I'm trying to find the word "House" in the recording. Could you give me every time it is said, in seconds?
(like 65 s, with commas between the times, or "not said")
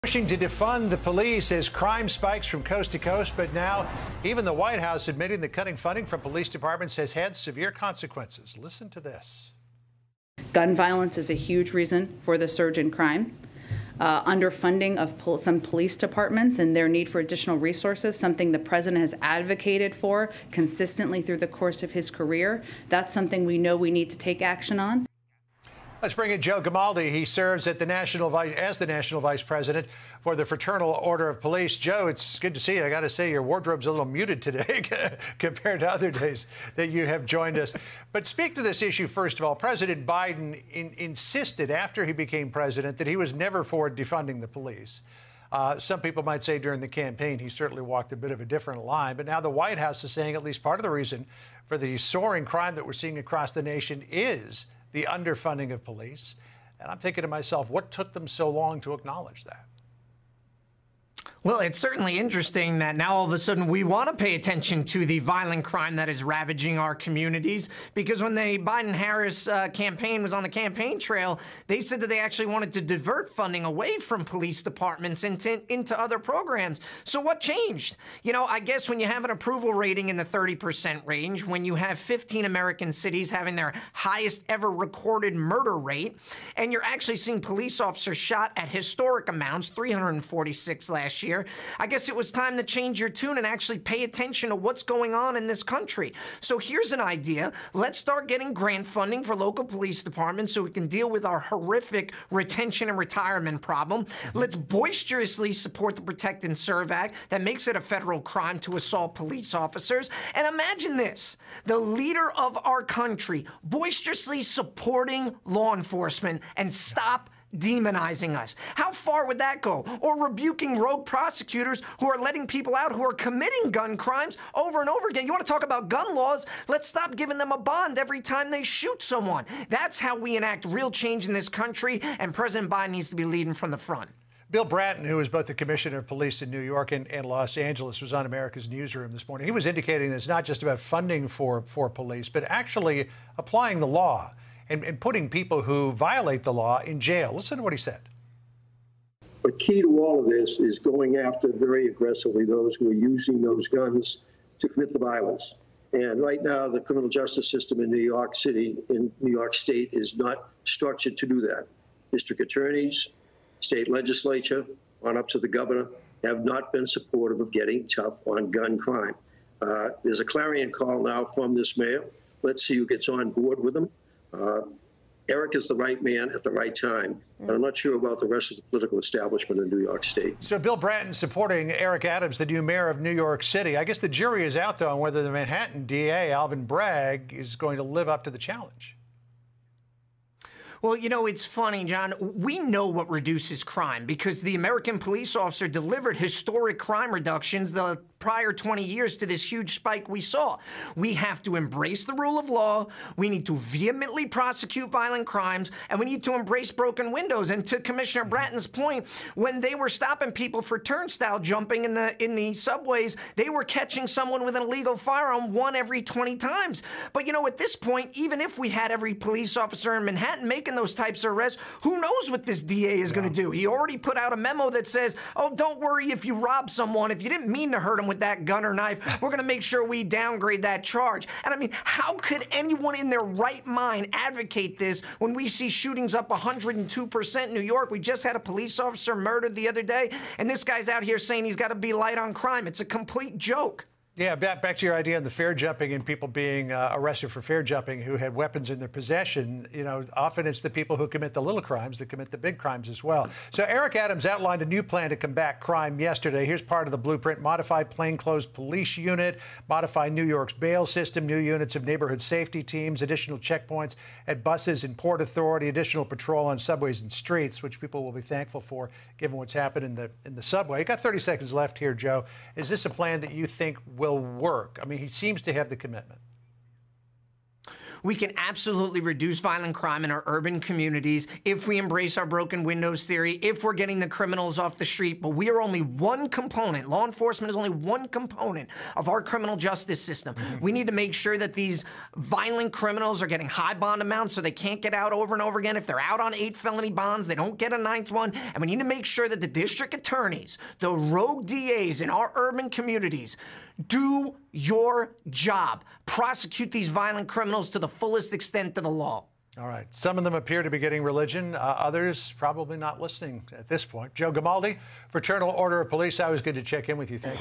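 4 s, 49 s.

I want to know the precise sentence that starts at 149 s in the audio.
But key to all of this is going after very aggressively those who are using those guns to commit the violence.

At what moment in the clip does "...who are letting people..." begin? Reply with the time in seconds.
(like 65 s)
121 s.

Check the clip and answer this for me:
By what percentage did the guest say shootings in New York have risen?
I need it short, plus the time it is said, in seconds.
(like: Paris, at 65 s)
102%, at 236 s.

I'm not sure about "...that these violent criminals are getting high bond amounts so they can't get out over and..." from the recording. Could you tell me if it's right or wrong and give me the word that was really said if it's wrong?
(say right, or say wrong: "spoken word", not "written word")
right.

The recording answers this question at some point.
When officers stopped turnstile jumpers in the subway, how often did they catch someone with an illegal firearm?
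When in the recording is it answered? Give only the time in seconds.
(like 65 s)
215 s.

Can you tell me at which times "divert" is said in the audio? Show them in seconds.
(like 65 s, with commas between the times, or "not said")
72 s.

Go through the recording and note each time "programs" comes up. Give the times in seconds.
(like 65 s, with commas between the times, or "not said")
76 s.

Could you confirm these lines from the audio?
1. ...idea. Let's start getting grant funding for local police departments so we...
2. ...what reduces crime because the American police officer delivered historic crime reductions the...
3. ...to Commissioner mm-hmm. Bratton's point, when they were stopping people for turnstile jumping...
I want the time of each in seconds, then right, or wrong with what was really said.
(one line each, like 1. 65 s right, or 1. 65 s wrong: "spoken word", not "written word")
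1. 97 s right
2. 192 s right
3. 207 s right.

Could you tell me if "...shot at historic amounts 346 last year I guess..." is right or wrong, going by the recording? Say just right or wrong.
right.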